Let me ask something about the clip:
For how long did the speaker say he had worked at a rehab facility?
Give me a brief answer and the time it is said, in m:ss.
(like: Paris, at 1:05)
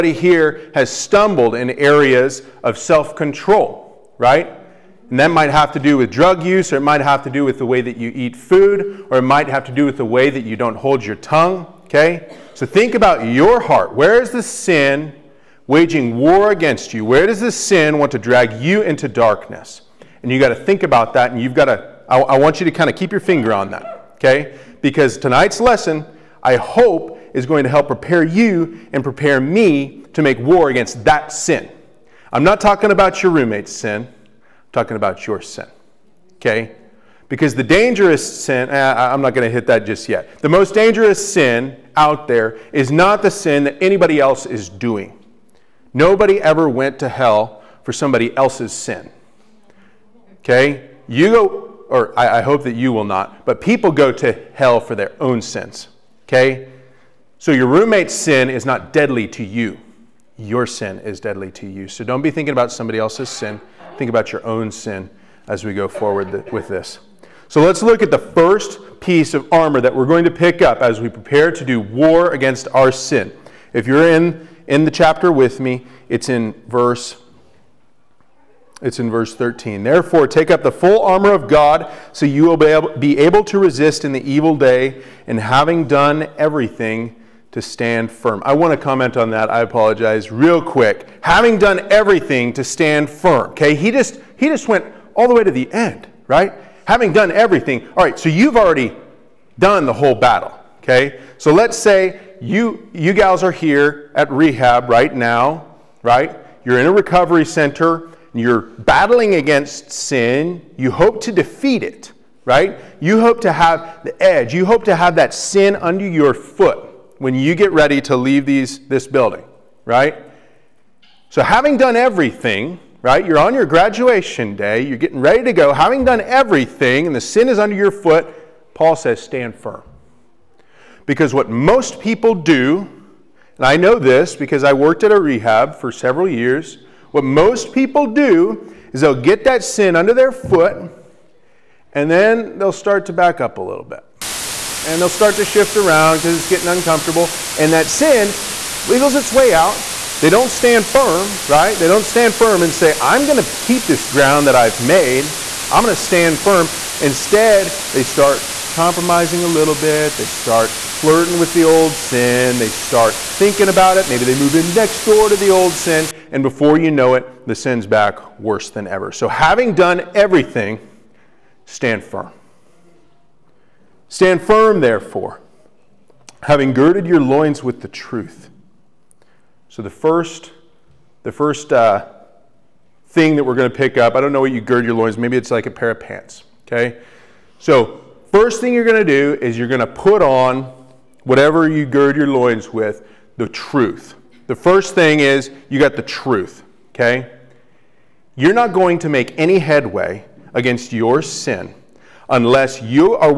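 Several years, at 2:15.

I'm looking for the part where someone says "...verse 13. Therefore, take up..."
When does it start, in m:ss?
1:19.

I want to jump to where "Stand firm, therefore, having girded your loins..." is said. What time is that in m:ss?
2:54.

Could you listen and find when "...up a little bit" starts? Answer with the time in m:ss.
2:23.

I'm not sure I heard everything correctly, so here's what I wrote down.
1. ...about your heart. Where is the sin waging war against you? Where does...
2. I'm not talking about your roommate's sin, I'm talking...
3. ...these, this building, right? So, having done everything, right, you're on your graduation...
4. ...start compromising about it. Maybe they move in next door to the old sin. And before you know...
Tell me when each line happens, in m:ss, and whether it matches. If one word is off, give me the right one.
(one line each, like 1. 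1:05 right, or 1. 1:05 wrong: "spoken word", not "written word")
1. 0:12 right
2. 0:32 right
3. 1:58 right
4. 2:42 wrong: "thinking", not "compromising".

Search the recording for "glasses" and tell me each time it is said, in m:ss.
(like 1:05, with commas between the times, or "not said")
not said.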